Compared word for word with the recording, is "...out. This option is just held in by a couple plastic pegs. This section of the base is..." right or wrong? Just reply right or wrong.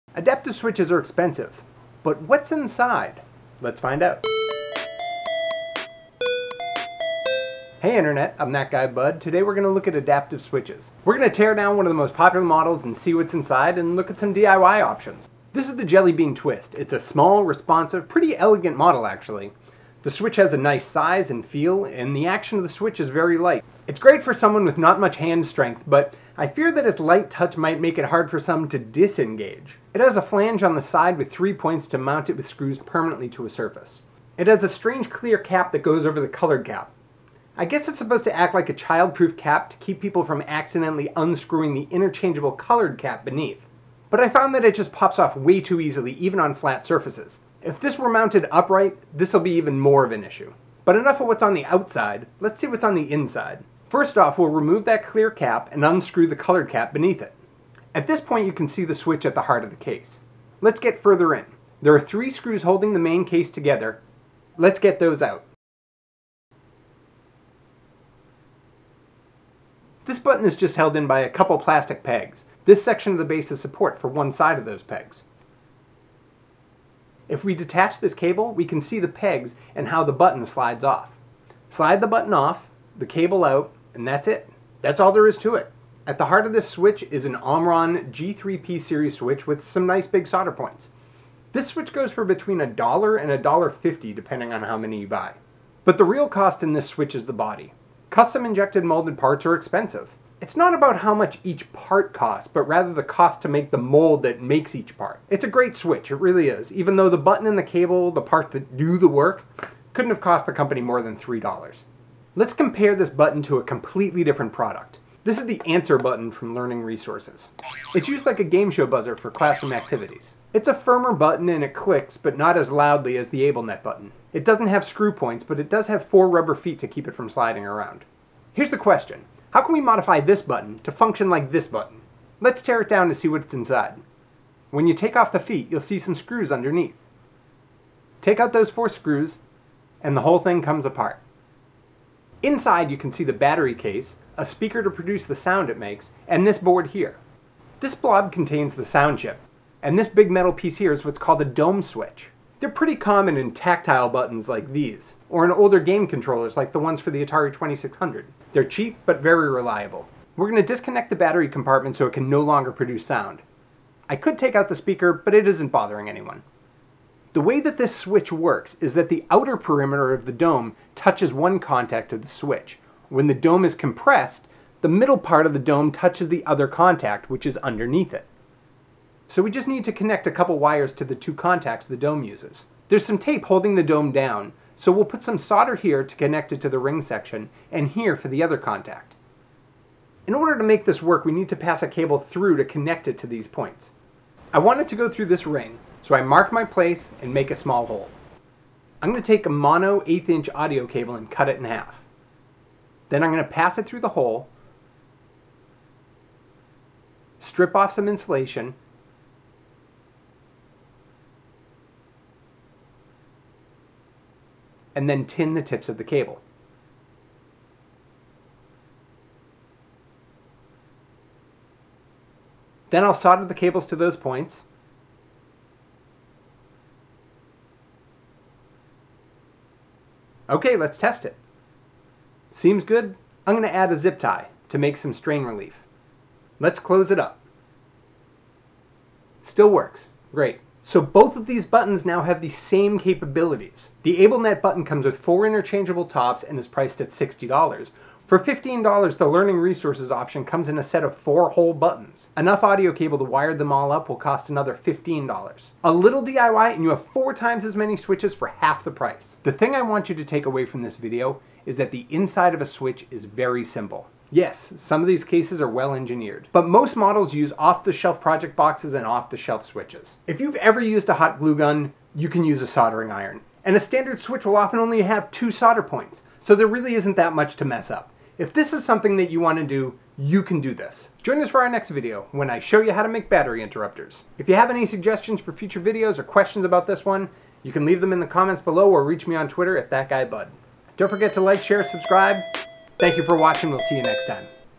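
wrong.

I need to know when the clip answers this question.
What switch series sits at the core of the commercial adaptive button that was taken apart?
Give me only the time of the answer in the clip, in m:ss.
1:27.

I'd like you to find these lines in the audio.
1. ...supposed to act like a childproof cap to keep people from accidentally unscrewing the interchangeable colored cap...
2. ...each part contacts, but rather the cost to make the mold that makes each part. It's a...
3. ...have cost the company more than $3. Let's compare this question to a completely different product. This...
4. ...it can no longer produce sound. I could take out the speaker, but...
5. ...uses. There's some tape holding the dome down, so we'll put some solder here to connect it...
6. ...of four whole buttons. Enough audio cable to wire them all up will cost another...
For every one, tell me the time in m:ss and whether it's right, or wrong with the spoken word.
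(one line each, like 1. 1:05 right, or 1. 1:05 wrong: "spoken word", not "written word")
1. 0:37 right
2. 1:41 wrong: "costs", not "contacts"
3. 1:50 wrong: "button", not "question"
4. 2:42 right
5. 3:02 right
6. 4:11 right.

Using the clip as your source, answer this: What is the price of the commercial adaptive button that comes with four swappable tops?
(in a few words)
$60.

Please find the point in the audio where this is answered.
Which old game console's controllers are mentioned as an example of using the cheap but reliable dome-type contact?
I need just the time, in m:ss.
2:37.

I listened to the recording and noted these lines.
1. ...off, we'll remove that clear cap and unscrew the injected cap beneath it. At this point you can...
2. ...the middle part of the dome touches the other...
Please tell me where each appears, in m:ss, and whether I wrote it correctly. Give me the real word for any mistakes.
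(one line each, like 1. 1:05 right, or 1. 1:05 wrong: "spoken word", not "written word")
1. 0:54 wrong: "colored", not "injected"
2. 2:54 right.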